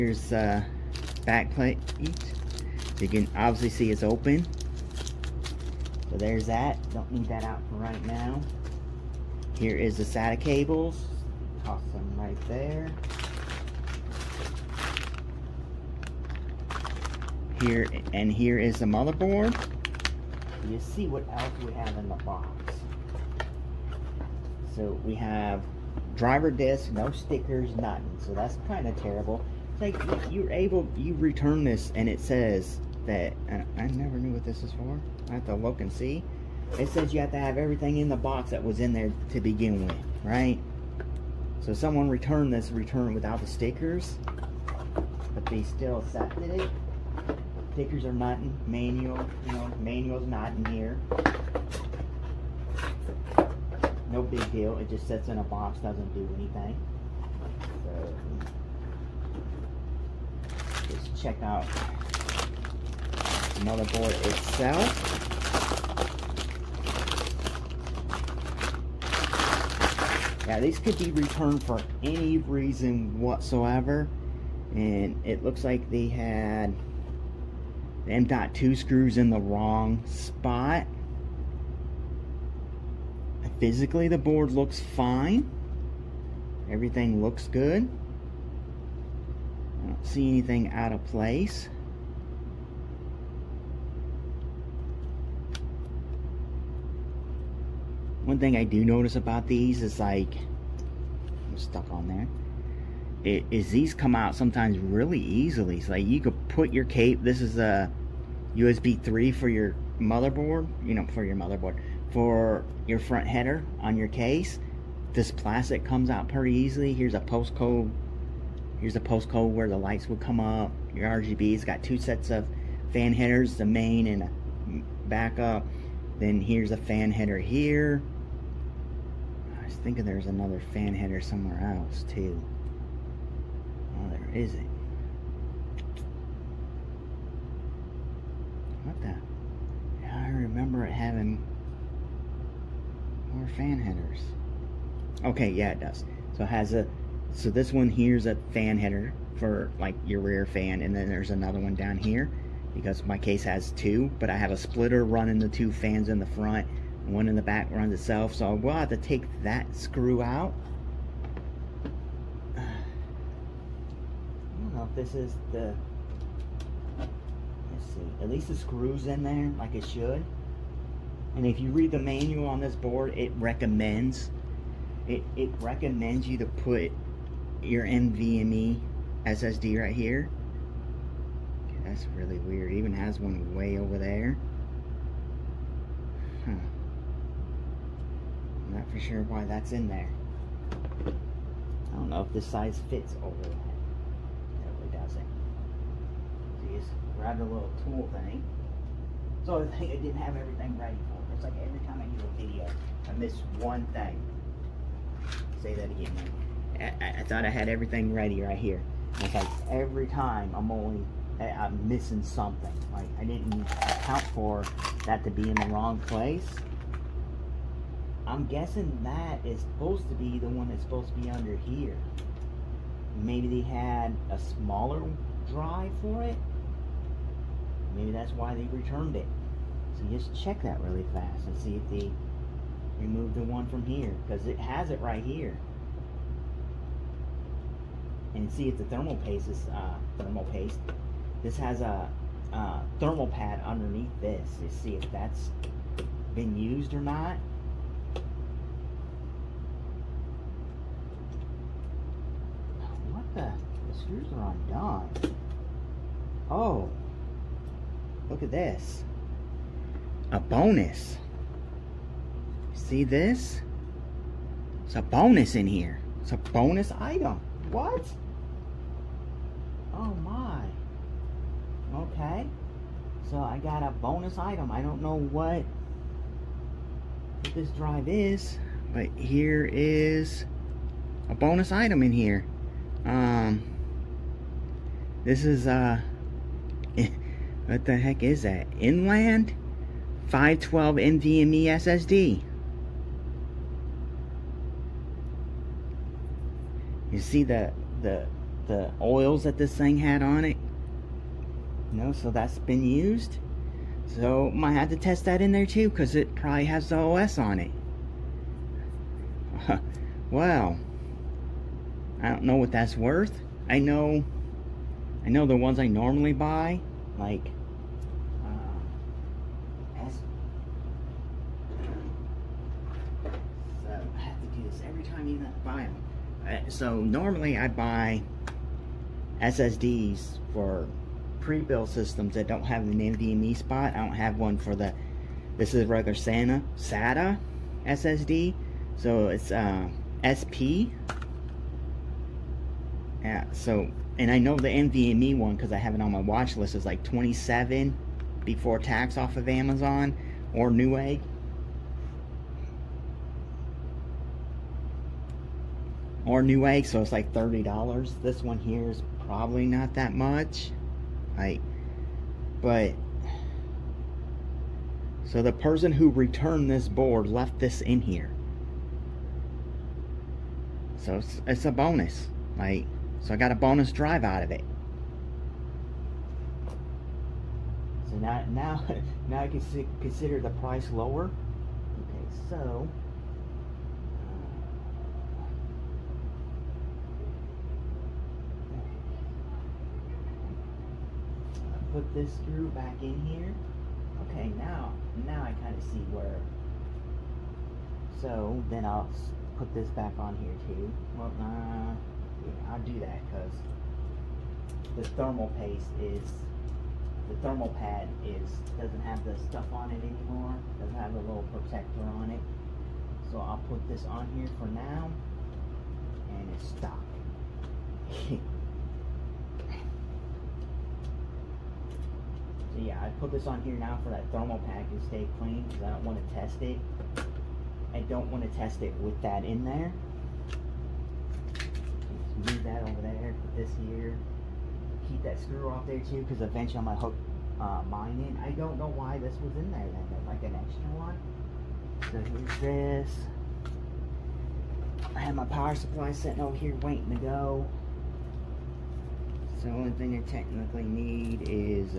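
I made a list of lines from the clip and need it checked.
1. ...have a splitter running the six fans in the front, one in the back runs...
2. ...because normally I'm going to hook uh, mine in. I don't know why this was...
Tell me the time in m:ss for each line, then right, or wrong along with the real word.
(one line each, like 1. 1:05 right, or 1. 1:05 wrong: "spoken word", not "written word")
1. 2:34 wrong: "two", not "six"
2. 7:16 wrong: "eventually", not "normally".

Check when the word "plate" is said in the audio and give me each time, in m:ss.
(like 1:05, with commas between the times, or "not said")
0:01.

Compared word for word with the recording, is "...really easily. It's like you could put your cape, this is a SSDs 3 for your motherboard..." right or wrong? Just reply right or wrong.
wrong.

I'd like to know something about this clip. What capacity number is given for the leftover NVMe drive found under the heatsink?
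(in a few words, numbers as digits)
512.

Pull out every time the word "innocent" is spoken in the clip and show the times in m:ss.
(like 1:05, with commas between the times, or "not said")
not said.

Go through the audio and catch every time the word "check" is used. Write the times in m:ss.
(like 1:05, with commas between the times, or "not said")
1:01, 3:50.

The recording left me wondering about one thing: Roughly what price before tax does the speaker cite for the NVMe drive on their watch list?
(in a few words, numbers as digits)
$27.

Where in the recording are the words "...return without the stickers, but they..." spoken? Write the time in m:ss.
0:42.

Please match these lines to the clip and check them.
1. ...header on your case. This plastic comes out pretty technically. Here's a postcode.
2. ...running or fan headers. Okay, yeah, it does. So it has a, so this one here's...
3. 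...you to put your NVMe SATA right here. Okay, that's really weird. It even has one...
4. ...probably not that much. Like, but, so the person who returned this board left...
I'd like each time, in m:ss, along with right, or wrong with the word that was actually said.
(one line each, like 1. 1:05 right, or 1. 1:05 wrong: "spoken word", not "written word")
1. 1:53 wrong: "easily", not "technically"
2. 2:20 wrong: "having", not "running"
3. 2:56 wrong: "SSD", not "SATA"
4. 5:59 right.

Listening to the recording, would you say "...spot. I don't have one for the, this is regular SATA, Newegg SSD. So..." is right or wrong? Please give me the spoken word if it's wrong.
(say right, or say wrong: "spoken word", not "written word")
wrong: "SATA", not "Newegg".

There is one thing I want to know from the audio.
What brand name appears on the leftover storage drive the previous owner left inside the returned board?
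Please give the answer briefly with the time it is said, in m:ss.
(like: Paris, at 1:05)
Inland, at 4:48.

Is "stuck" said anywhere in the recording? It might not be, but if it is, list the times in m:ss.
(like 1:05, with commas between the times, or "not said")
1:41, 6:56.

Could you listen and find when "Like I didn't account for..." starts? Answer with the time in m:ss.
3:32.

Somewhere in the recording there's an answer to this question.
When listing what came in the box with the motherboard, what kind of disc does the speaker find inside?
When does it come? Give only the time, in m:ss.
0:26.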